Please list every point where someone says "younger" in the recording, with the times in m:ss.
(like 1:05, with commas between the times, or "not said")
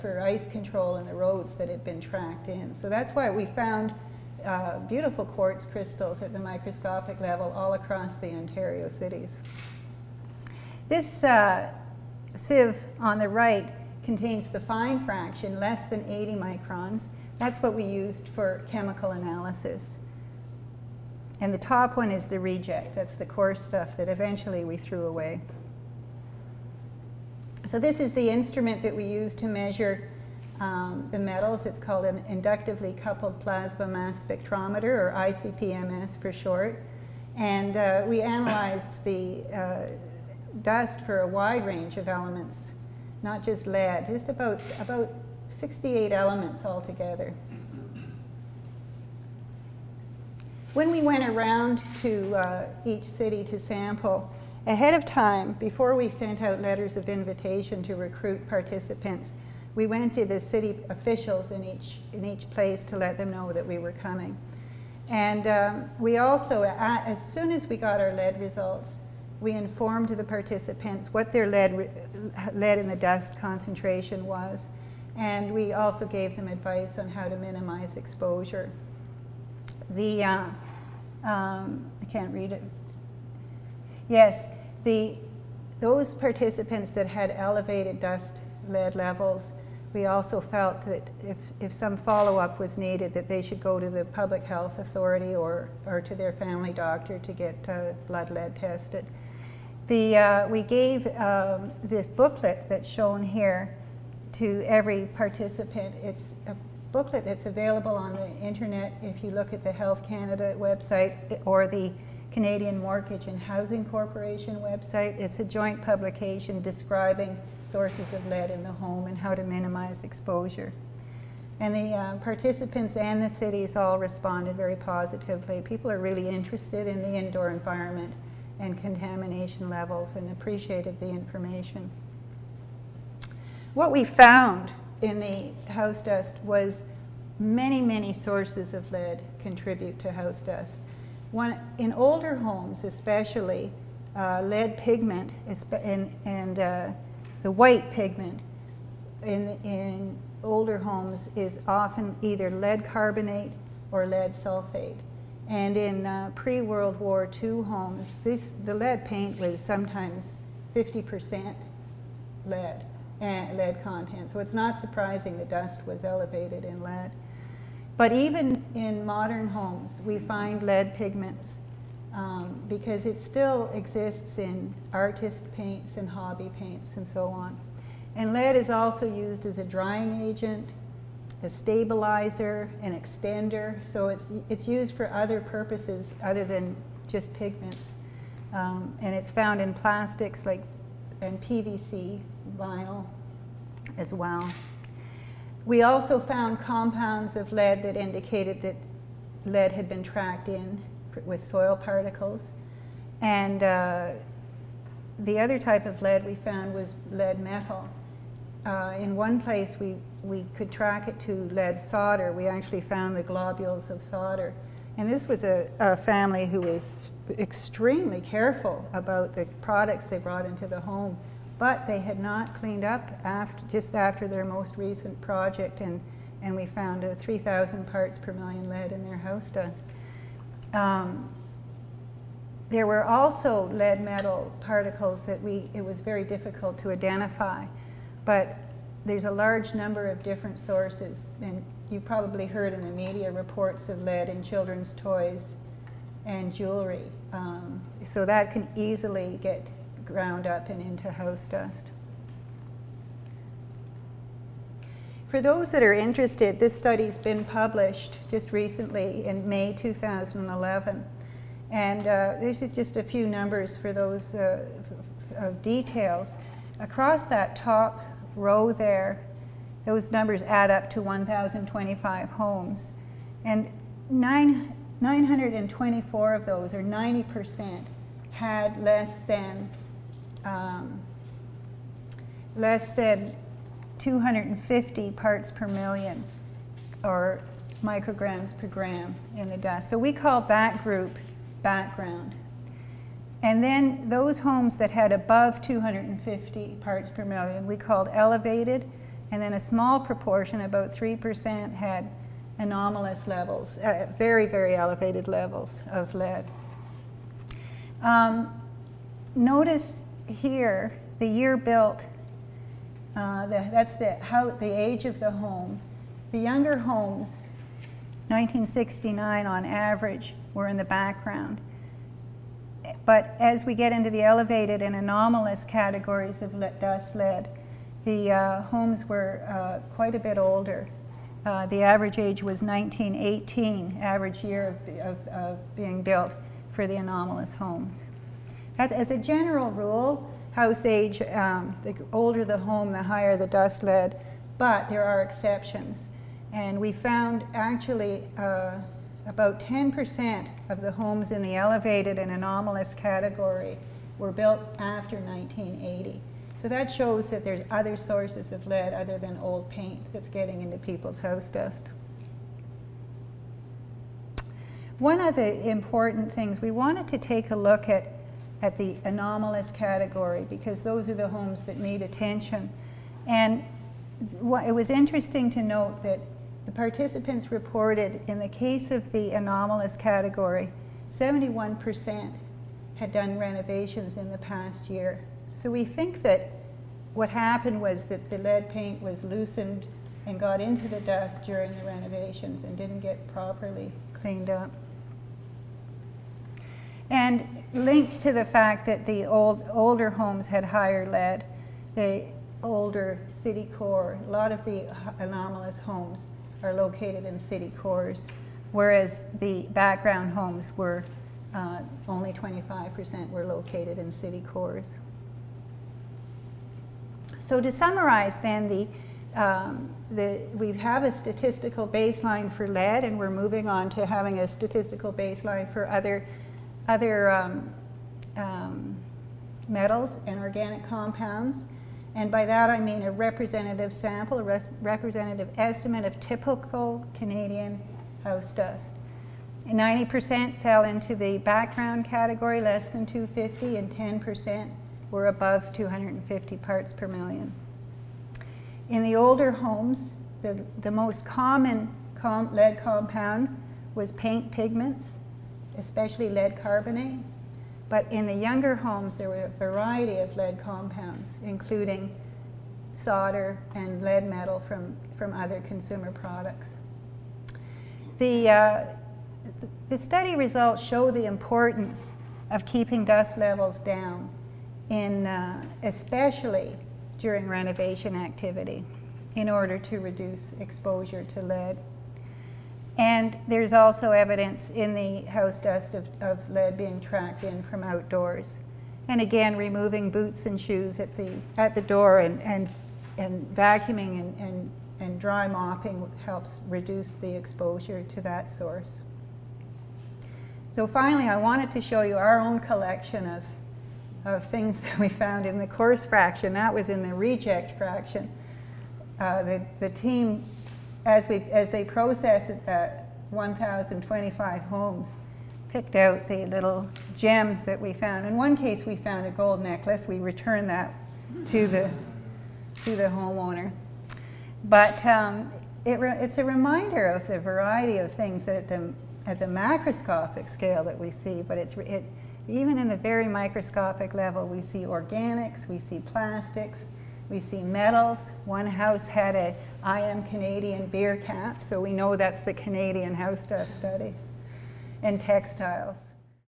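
5:16, 7:38.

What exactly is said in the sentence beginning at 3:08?
Um, and it's found in plastics like and PVC vinyl as well.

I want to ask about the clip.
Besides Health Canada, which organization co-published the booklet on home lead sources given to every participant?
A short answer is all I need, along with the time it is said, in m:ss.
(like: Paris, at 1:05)
Canadian Mortgage and Housing Corporation, at 1:52.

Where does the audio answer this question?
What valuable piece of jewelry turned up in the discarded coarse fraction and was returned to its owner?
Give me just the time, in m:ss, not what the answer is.
8:39.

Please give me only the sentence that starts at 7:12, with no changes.
And by that I mean a representative sample, a res representative estimate of typical Canadian house dust.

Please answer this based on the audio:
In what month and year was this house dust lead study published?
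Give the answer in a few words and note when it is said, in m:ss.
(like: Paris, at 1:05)
May 2011, at 4:19.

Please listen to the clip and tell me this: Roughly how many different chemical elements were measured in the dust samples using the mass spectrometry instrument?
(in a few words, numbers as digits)
68.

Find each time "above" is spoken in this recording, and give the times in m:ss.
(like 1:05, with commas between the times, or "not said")
4:55, 7:25.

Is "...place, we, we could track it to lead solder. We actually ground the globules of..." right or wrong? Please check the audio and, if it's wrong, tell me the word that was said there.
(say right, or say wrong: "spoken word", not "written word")
wrong: "found", not "ground".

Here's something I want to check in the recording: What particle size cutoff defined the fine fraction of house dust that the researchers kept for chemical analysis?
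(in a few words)
80 microns.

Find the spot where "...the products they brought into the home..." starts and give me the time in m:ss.
3:39.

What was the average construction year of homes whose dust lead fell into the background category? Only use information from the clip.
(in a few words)
1969.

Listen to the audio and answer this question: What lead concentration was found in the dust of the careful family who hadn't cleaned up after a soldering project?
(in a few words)
3,000 parts per million.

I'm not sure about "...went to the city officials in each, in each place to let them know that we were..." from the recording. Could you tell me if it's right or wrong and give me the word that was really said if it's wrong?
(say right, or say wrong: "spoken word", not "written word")
right.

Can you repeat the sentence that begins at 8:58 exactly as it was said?
One house had a I am Canadian beer cap, so we know that's the Canadian house to study.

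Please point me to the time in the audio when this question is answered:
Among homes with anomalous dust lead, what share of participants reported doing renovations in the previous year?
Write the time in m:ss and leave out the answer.
6:21.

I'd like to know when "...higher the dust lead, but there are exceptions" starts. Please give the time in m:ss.
5:43.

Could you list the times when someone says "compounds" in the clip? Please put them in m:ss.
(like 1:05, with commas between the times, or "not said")
3:16, 7:10, 7:32, 7:40.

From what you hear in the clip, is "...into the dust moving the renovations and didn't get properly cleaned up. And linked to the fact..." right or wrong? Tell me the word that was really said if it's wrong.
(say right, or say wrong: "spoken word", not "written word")
wrong: "during", not "moving".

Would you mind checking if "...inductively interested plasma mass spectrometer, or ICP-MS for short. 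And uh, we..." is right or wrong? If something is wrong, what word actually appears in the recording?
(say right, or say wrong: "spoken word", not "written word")
wrong: "coupled", not "interested".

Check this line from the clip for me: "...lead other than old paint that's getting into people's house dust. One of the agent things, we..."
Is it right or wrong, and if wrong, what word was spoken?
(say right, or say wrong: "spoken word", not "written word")
wrong: "important", not "agent".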